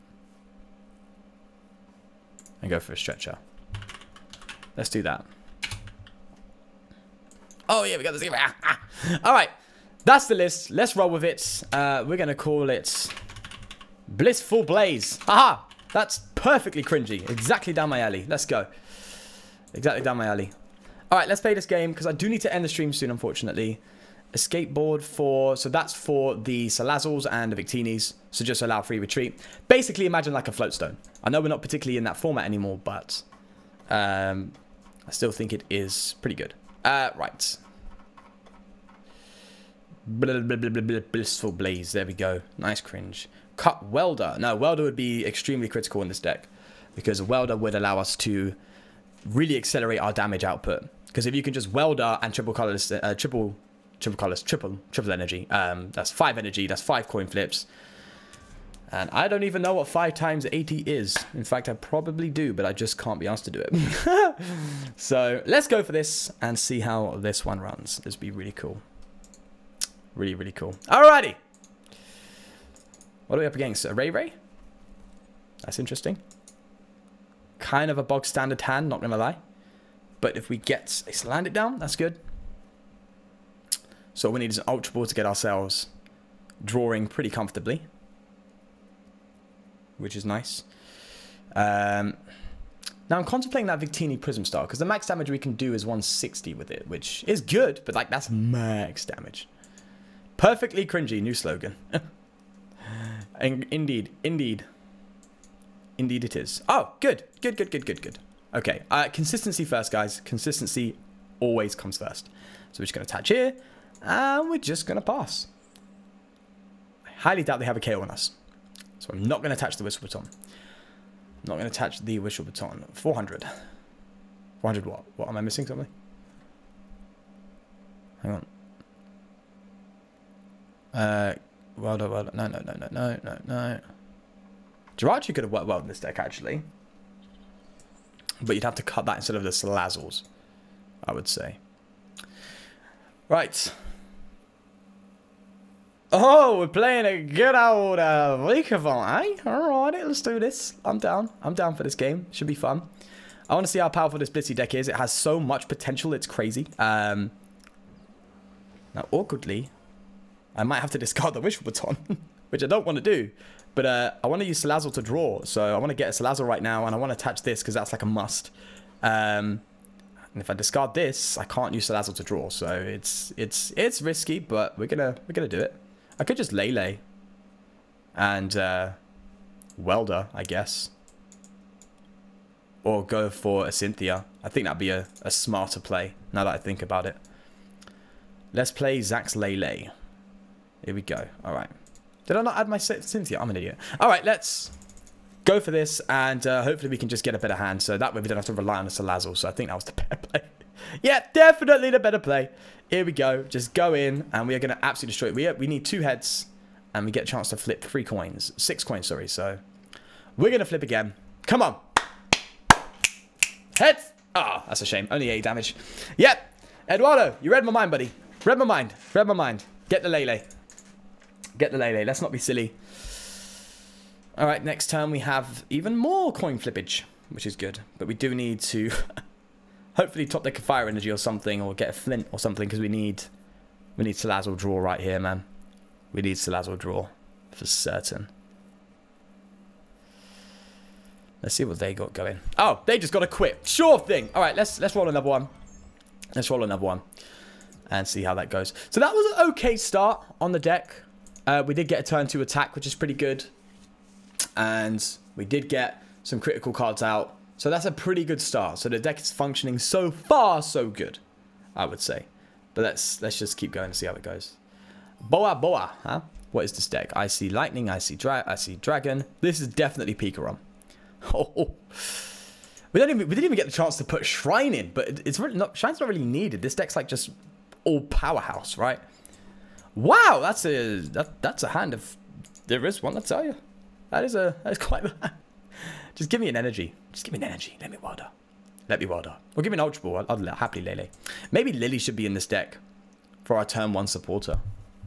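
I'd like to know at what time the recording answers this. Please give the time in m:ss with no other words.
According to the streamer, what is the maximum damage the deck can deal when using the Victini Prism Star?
1:35.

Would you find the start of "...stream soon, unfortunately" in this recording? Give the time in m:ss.
0:22.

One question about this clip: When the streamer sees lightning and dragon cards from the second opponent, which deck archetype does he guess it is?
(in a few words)
Pikarom.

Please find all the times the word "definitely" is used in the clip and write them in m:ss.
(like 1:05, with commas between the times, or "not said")
3:21, 4:29.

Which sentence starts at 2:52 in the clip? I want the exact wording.
So it's it's it's risky, but we're gonna we're gonna do it.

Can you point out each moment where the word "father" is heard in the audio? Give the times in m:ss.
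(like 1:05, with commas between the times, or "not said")
not said.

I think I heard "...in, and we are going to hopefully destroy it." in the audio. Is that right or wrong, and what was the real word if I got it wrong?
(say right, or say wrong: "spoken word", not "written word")
wrong: "absolutely", not "hopefully".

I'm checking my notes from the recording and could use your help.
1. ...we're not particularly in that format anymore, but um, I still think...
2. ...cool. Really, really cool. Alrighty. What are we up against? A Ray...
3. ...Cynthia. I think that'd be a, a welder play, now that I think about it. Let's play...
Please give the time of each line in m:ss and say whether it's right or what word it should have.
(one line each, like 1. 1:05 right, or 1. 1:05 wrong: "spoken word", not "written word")
1. 0:31 right
2. 1:08 right
3. 3:03 wrong: "smarter", not "welder".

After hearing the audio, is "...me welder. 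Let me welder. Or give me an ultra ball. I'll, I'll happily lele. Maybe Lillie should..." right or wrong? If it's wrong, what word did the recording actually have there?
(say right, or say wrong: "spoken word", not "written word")
right.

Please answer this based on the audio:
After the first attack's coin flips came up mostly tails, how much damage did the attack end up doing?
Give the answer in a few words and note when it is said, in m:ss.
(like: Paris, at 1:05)
8, at 3:35.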